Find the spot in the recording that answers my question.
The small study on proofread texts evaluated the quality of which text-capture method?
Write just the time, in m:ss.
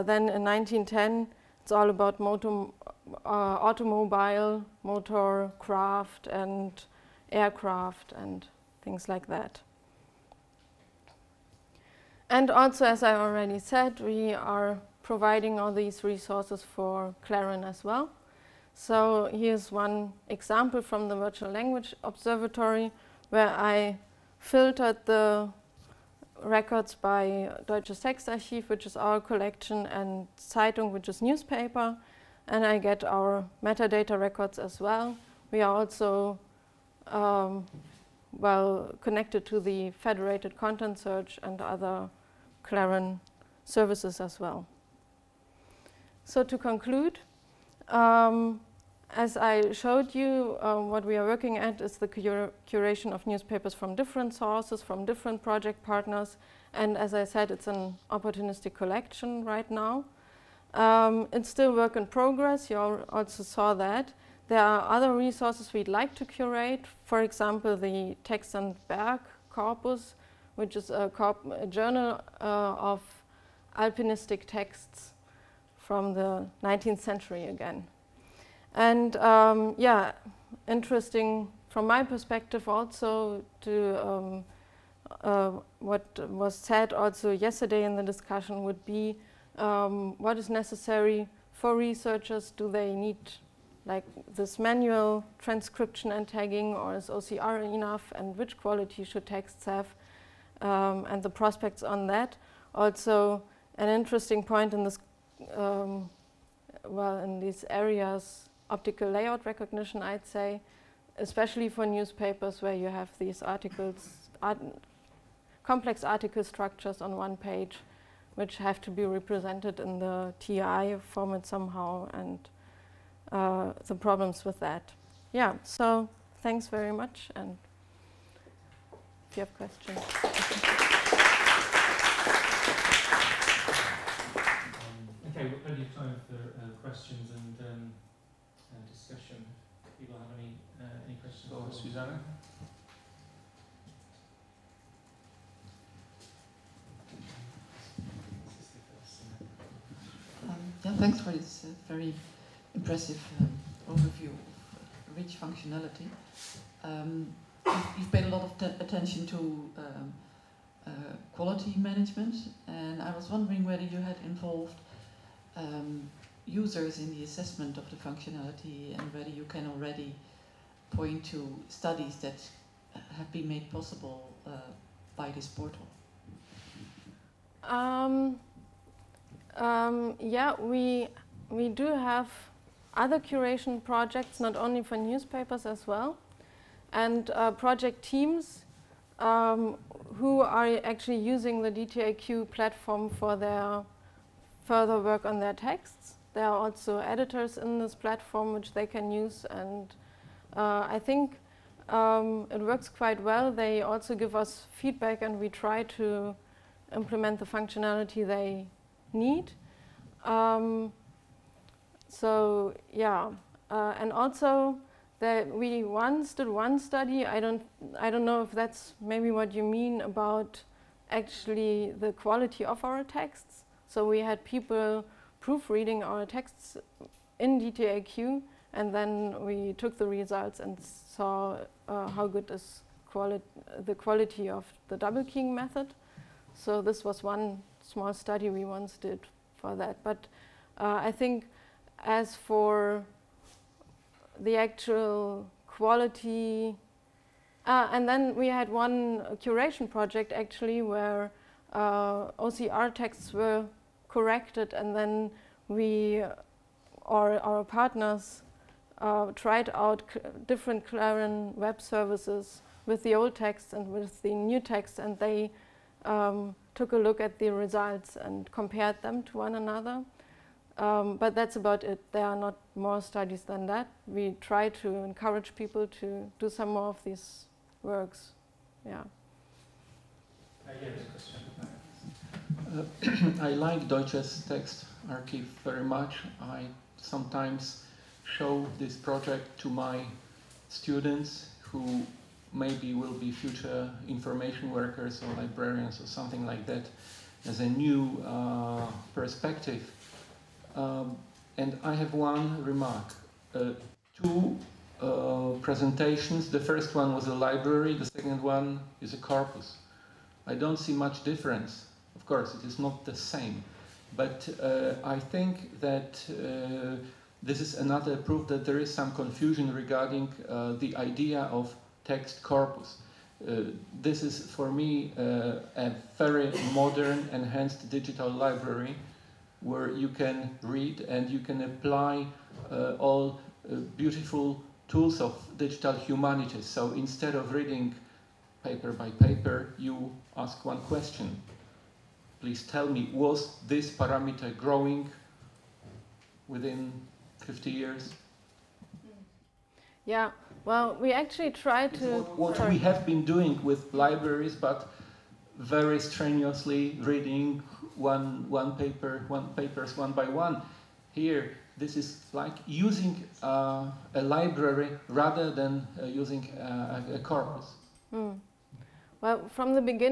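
3:54.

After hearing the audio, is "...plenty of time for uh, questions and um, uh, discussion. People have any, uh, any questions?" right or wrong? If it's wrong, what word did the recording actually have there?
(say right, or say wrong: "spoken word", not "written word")
right.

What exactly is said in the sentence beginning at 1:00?
Um, it's still work in progress, you also saw that.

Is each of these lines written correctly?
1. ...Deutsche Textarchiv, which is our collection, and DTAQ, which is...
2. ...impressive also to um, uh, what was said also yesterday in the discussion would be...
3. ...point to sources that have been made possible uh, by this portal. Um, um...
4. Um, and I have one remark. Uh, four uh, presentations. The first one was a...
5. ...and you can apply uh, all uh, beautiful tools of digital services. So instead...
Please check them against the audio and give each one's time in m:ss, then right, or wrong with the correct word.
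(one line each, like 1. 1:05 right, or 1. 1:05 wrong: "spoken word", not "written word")
1. 0:27 wrong: "Zeitung", not "DTAQ"
2. 1:22 wrong: "perspective", not "impressive"
3. 2:50 wrong: "studies", not "sources"
4. 5:00 wrong: "two", not "four"
5. 5:31 wrong: "humanities", not "services".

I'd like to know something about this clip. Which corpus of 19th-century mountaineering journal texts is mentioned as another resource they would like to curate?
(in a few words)
Text and Berg.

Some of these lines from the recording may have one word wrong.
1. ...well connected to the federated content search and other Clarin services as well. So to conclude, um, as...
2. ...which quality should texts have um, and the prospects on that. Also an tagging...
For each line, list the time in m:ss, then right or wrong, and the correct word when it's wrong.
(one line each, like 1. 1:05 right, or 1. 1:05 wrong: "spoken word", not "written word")
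1. 0:38 right
2. 1:38 wrong: "interesting", not "tagging".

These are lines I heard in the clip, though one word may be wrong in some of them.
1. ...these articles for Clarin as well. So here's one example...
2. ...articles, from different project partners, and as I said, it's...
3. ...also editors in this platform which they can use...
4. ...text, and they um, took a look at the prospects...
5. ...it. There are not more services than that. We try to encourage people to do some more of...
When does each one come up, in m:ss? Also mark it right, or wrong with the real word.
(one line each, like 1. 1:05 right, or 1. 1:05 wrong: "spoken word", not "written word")
1. 0:15 wrong: "resources", not "articles"
2. 0:54 wrong: "sources", not "articles"
3. 3:16 right
4. 4:24 wrong: "results", not "prospects"
5. 4:31 wrong: "studies", not "services".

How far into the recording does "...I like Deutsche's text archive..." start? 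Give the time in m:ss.
4:43.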